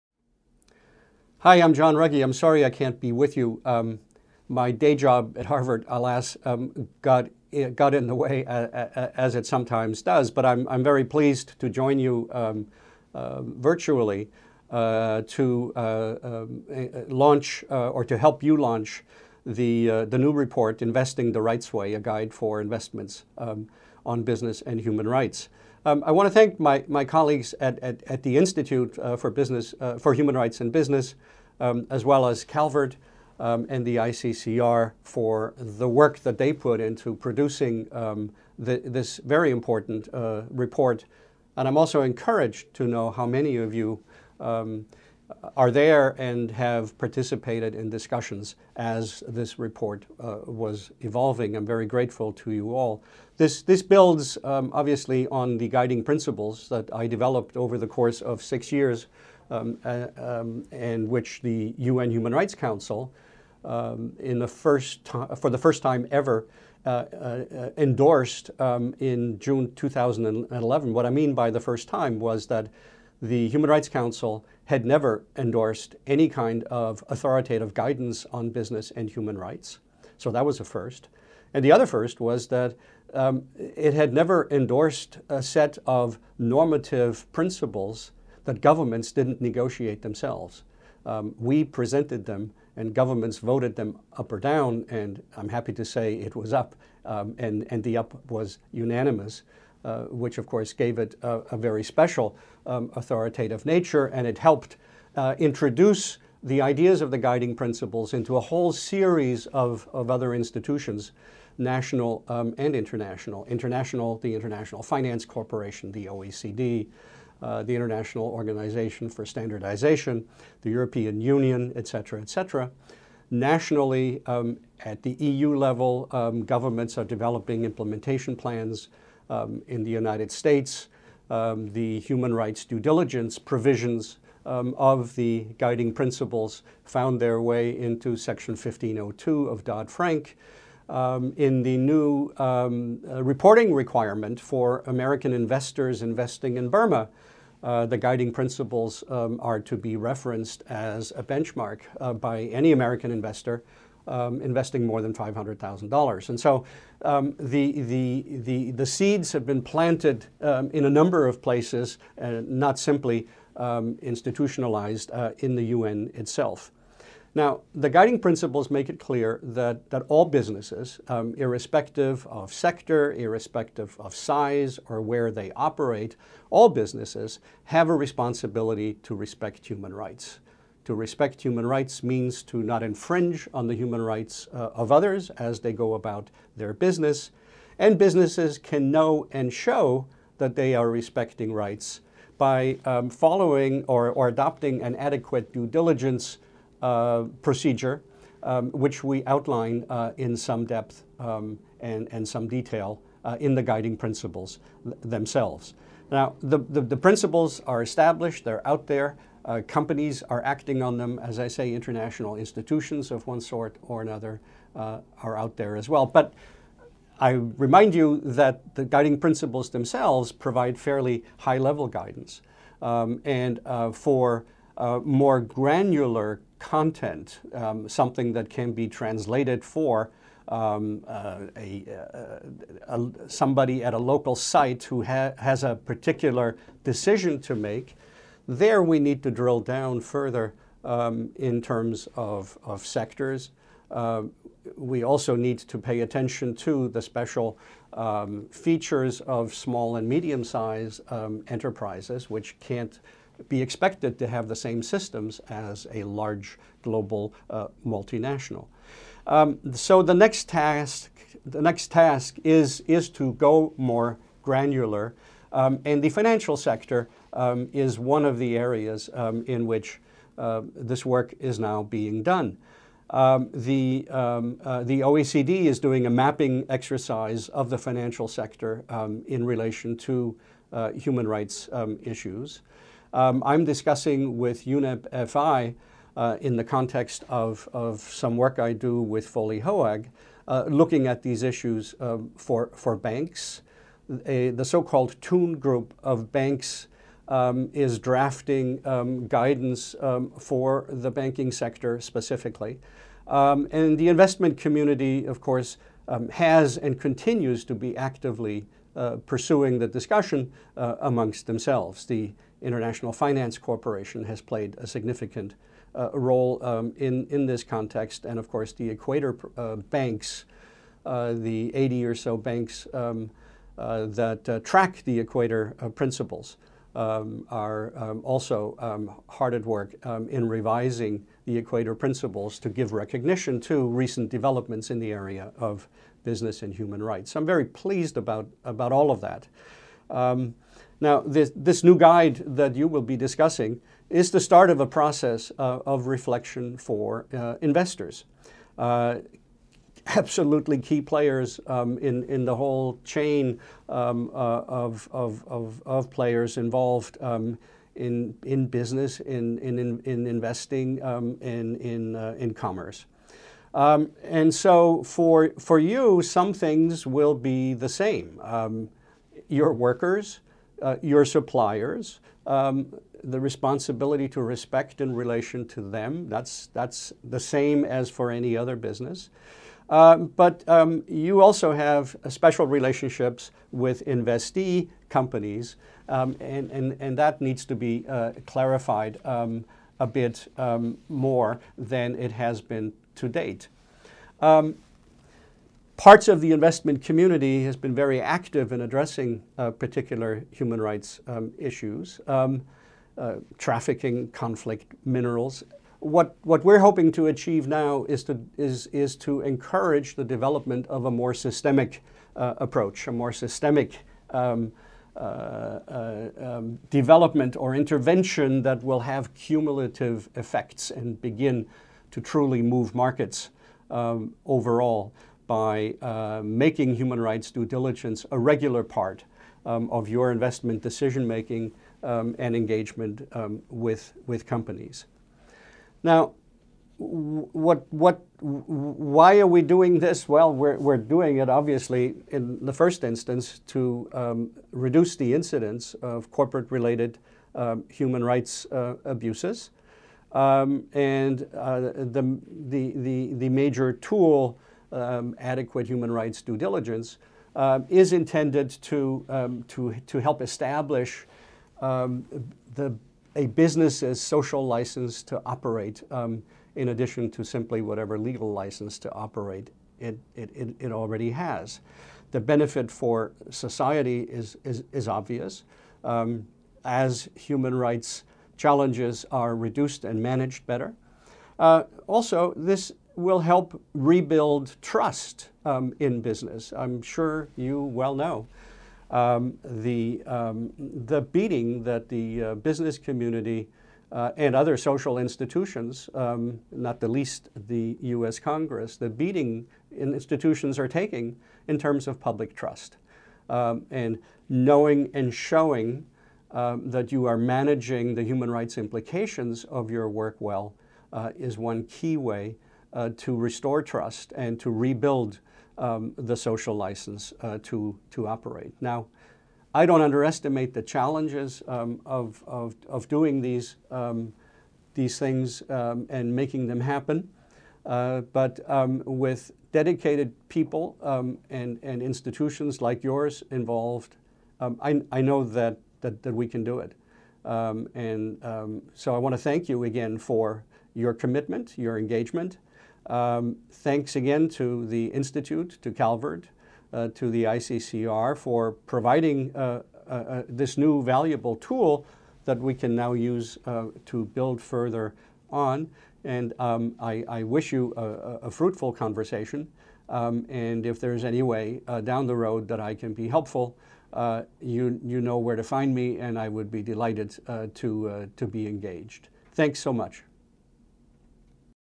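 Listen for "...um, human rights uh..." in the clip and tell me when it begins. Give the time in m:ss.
7:27.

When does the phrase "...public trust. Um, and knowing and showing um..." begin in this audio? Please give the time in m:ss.
8:22.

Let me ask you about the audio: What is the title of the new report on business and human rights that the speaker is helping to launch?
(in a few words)
Investing the Rights Way.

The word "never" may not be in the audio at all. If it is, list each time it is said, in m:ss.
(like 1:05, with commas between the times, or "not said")
1:14, 1:24.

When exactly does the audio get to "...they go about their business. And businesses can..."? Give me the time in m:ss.
3:05.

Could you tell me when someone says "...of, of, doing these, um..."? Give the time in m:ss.
8:42.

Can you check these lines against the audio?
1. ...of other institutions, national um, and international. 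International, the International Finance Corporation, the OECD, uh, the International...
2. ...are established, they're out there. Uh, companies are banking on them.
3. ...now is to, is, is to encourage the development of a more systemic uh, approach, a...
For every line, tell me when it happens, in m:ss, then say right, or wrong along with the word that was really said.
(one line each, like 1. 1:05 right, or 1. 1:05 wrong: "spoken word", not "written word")
1. 1:49 right
2. 3:27 wrong: "acting", not "banking"
3. 6:47 right.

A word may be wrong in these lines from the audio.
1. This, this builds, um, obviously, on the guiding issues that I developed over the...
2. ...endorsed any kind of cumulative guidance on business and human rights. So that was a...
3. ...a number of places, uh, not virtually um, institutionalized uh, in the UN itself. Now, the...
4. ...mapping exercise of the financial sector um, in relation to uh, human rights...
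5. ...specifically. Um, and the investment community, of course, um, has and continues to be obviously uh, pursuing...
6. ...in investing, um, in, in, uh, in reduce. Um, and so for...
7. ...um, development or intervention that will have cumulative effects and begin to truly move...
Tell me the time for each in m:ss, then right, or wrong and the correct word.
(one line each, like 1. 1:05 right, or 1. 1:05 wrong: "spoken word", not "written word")
1. 0:53 wrong: "principles", not "issues"
2. 1:15 wrong: "authoritative", not "cumulative"
3. 2:40 wrong: "simply", not "virtually"
4. 4:36 right
5. 5:02 wrong: "actively", not "obviously"
6. 6:00 wrong: "commerce", not "reduce"
7. 6:56 right.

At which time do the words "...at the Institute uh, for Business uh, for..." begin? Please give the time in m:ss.
0:28.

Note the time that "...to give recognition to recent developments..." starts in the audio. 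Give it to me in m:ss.
5:32.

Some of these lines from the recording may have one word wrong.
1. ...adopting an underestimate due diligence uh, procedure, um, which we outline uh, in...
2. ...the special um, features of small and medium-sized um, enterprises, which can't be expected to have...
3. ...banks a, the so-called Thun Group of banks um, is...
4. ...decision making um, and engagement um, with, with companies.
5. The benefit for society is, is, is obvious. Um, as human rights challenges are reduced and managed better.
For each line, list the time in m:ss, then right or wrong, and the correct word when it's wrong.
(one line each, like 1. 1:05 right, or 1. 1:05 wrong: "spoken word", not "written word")
1. 3:14 wrong: "adequate", not "underestimate"
2. 4:06 right
3. 4:52 right
4. 7:10 right
5. 7:52 right.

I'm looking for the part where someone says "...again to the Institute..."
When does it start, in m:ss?
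9:04.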